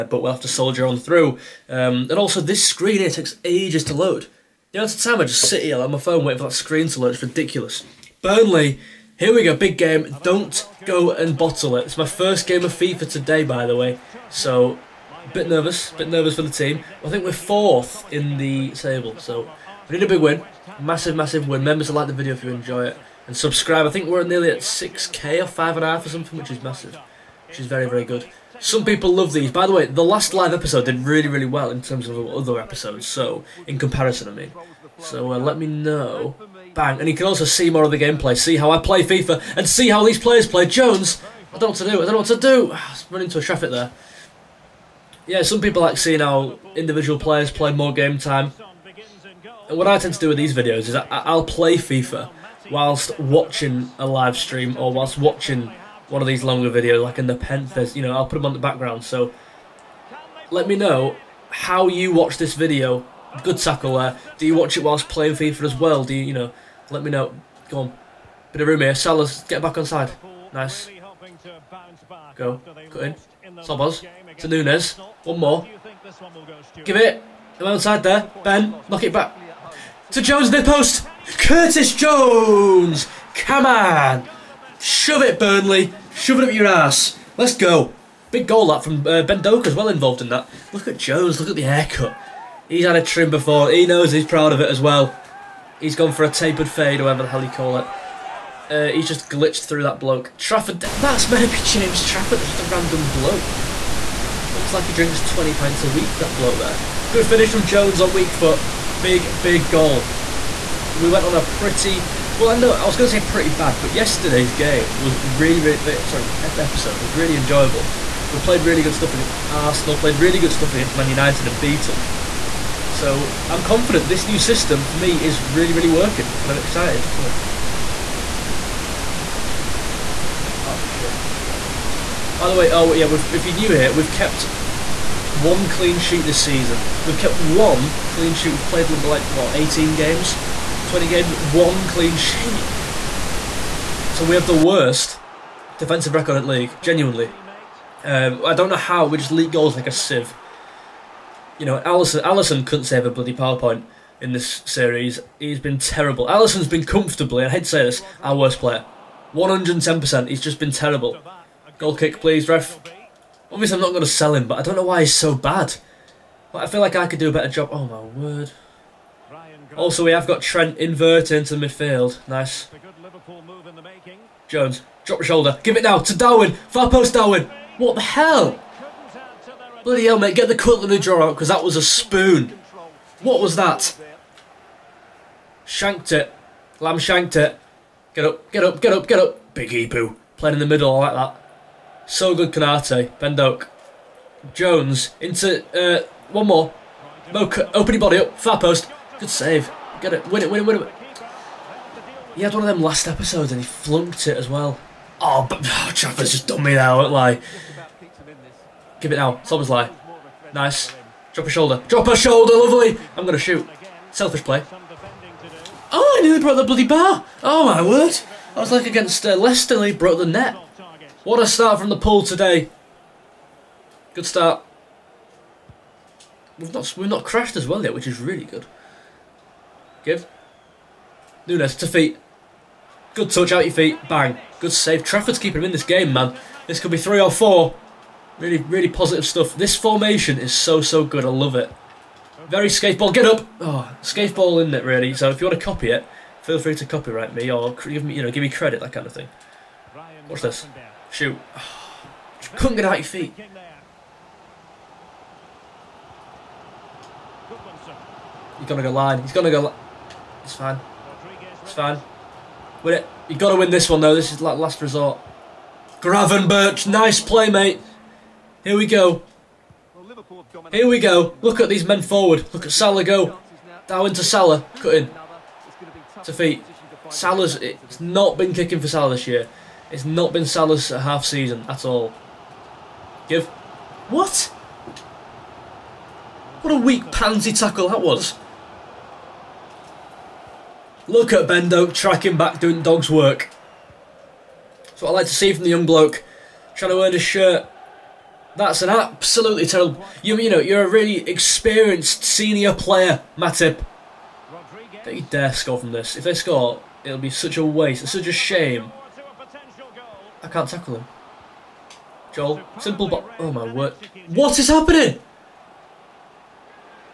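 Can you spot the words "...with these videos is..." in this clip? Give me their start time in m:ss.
0:50.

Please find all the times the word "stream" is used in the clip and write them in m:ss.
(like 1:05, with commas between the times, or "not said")
0:54.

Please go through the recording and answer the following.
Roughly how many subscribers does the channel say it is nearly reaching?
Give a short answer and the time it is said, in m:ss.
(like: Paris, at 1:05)
6k, at 0:24.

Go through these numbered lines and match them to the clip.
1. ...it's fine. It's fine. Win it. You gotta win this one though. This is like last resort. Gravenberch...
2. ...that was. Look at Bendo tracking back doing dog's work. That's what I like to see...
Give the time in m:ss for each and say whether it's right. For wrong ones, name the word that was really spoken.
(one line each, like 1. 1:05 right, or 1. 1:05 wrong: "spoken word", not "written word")
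1. 4:20 right
2. 4:47 right.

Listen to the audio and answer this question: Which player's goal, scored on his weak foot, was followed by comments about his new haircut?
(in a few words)
Curtis Jones.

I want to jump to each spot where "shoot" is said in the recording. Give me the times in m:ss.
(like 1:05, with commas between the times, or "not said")
3:33, 4:11.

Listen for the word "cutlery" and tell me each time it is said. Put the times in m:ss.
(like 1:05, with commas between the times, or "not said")
3:00.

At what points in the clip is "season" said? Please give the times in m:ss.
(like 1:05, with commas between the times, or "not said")
2:16, 4:41.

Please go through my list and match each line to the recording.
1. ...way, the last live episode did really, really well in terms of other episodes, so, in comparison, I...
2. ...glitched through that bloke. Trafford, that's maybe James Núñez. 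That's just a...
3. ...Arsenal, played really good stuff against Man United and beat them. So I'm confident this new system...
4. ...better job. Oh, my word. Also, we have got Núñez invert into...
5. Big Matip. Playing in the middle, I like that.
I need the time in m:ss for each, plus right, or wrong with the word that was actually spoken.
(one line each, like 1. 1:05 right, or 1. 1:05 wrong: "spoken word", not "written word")
1. 0:29 right
2. 1:39 wrong: "Trafford", not "Núñez"
3. 1:59 right
4. 2:47 wrong: "Trent", not "Núñez"
5. 3:09 wrong: "Ibou", not "Matip".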